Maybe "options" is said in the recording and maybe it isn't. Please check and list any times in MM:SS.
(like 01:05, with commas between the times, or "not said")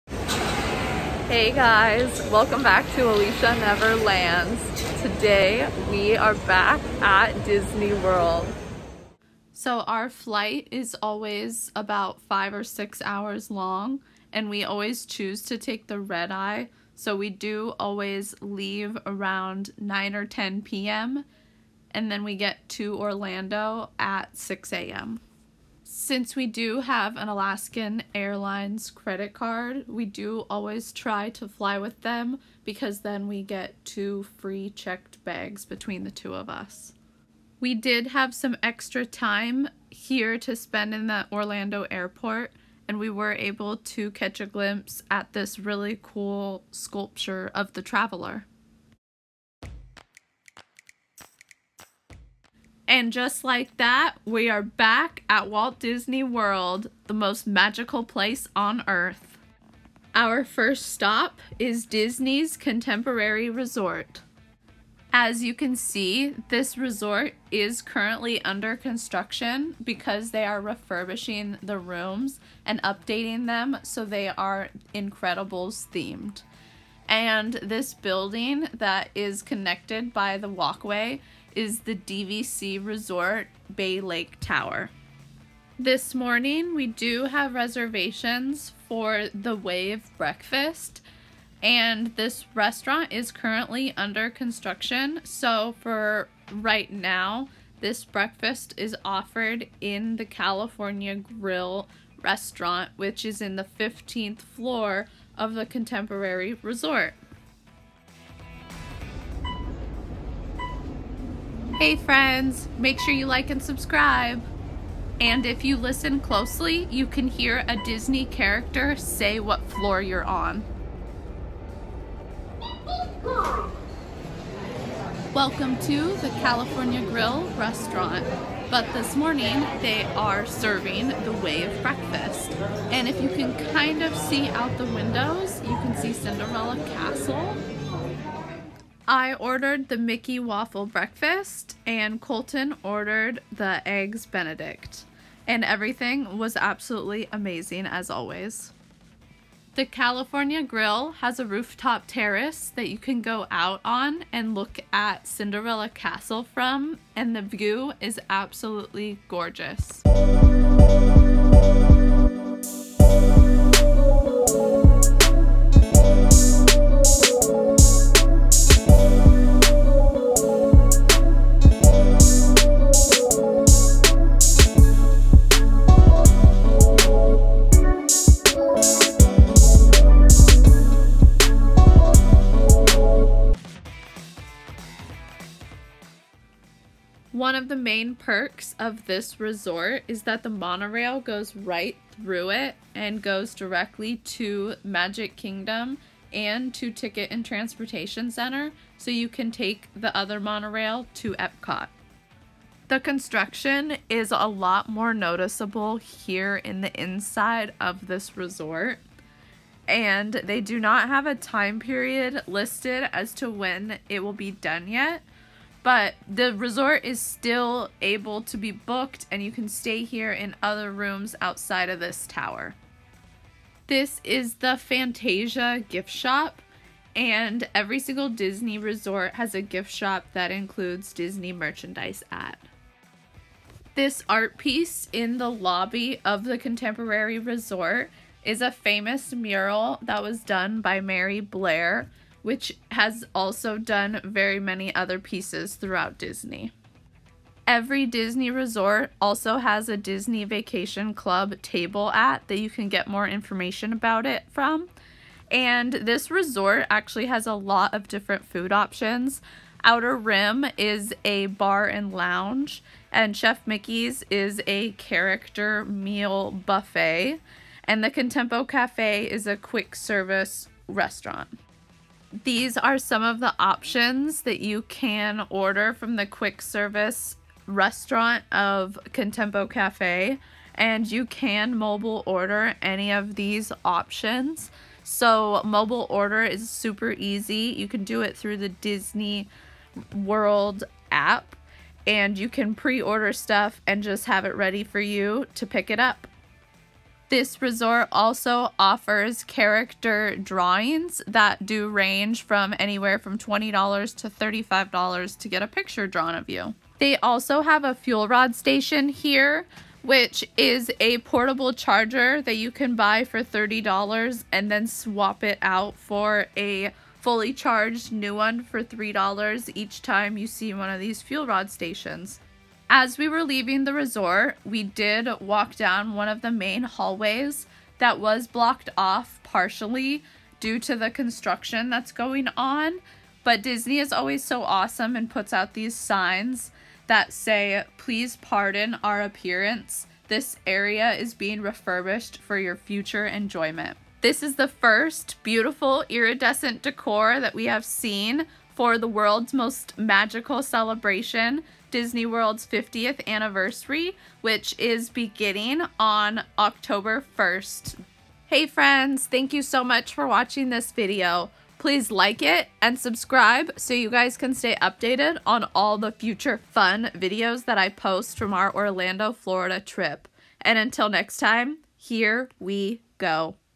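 04:18, 04:33, 04:43.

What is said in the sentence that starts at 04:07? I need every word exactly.
Every Disney resort also has a Disney Vacation Club table at that you can get more information about it from.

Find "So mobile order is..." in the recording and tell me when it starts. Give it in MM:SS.
04:45.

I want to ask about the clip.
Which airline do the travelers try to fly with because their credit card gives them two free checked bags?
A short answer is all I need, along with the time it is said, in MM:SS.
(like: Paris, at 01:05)
Alaskan Airlines, at 00:27.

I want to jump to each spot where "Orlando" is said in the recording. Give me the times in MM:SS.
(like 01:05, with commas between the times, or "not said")
00:22, 00:41, 06:08.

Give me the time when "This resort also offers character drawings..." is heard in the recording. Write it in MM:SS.
04:57.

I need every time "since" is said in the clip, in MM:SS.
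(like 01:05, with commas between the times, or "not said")
00:25.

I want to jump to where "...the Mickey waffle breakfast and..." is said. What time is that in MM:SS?
02:19.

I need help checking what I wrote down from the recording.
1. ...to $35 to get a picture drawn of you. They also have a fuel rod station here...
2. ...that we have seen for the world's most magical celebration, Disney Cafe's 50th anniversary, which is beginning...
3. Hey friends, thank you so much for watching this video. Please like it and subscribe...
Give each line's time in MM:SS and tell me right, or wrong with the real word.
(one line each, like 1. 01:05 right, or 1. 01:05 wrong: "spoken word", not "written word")
1. 05:04 right
2. 05:47 wrong: "World", not "Cafe"
3. 05:58 right.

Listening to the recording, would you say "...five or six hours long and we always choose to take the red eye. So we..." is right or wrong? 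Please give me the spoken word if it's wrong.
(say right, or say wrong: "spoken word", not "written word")
right.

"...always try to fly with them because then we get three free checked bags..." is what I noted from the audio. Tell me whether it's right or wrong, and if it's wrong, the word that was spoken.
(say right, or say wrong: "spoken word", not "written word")
wrong: "two", not "three".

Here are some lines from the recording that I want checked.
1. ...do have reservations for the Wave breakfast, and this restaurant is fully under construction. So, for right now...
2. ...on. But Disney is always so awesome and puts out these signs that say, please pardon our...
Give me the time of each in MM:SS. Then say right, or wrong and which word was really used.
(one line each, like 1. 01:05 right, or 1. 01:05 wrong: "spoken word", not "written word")
1. 01:26 wrong: "currently", not "fully"
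2. 05:32 right.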